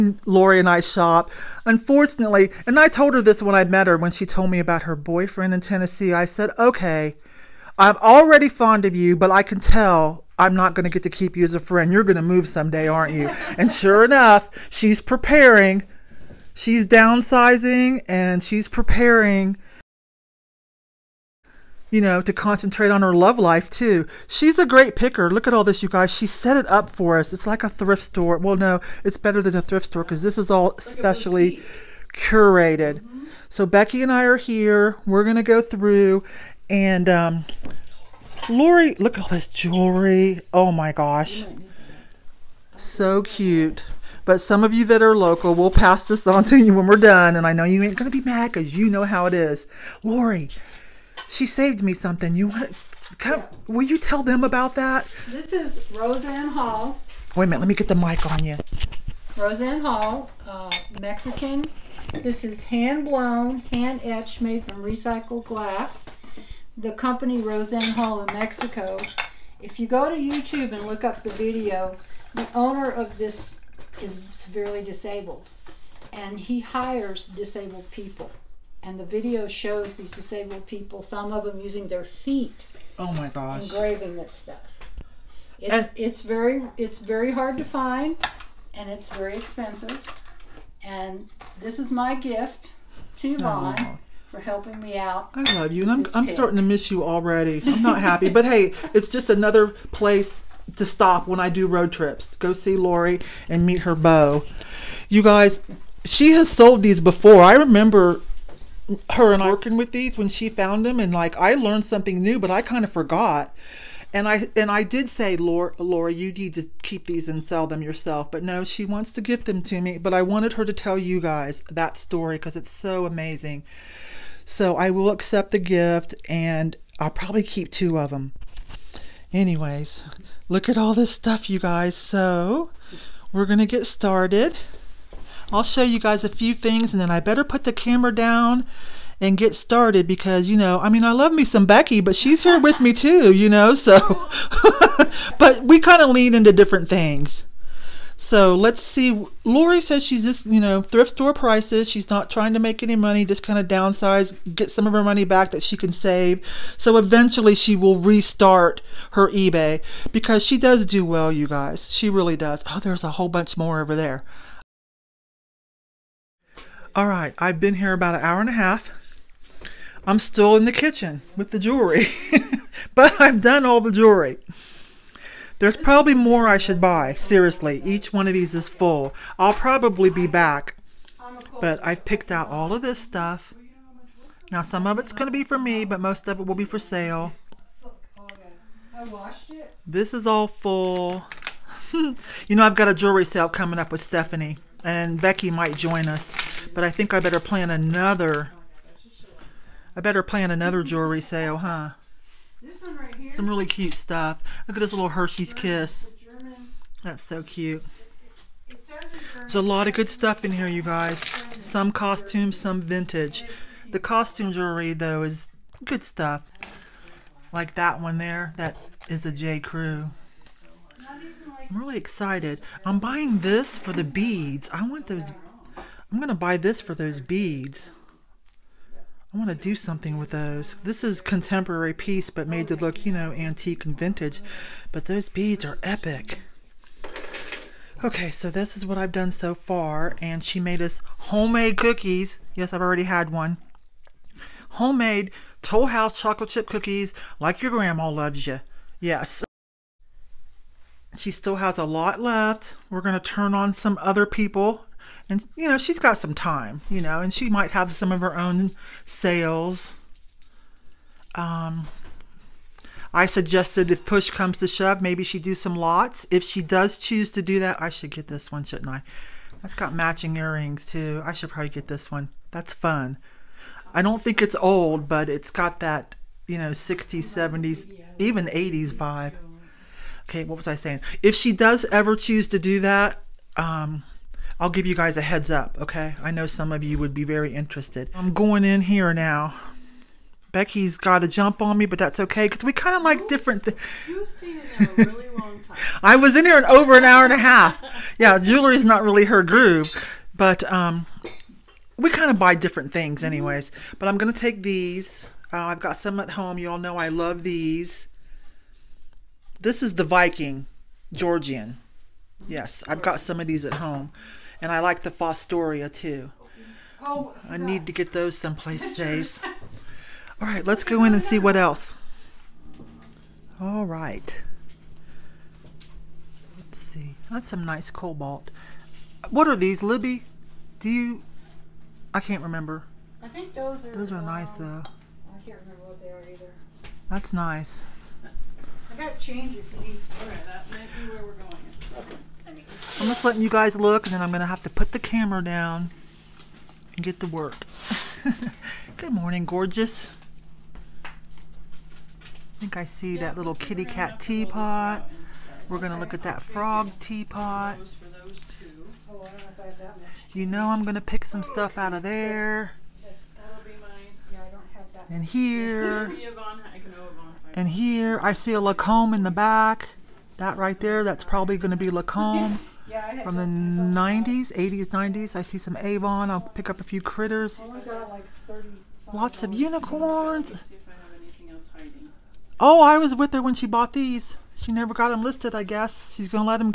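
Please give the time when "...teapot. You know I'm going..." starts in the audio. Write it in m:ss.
5:56.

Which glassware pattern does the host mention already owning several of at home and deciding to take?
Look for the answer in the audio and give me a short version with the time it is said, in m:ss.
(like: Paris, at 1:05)
Viking Georgian, at 5:10.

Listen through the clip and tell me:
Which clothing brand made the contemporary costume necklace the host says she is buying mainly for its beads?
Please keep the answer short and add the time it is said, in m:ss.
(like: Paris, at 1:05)
J. Crew, at 3:39.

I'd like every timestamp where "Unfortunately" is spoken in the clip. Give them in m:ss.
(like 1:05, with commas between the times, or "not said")
0:01.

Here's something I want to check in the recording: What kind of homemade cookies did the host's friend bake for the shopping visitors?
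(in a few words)
Toll House chocolate chip.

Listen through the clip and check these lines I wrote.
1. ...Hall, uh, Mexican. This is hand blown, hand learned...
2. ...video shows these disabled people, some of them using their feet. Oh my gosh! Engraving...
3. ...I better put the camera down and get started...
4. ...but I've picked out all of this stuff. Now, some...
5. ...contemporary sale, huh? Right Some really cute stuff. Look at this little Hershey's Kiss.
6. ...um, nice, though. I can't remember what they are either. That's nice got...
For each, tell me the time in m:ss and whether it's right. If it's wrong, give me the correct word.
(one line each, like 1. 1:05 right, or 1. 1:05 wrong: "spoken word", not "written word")
1. 0:59 wrong: "etched", not "learned"
2. 1:19 right
3. 2:17 right
4. 3:01 right
5. 3:20 wrong: "jewelry", not "contemporary"
6. 5:34 right.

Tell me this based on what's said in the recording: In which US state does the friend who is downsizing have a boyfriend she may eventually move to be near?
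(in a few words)
Tennessee.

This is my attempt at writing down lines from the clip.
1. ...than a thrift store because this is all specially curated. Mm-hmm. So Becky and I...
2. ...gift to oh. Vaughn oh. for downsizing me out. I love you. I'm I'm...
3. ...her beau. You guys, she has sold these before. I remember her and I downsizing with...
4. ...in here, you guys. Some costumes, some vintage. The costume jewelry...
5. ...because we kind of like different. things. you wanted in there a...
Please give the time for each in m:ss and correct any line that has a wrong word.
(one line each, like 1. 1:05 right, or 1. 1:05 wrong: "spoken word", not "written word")
1. 0:29 right
2. 1:32 wrong: "helping", not "downsizing"
3. 1:43 wrong: "working", not "downsizing"
4. 3:30 right
5. 4:52 wrong: "stayed", not "wanted".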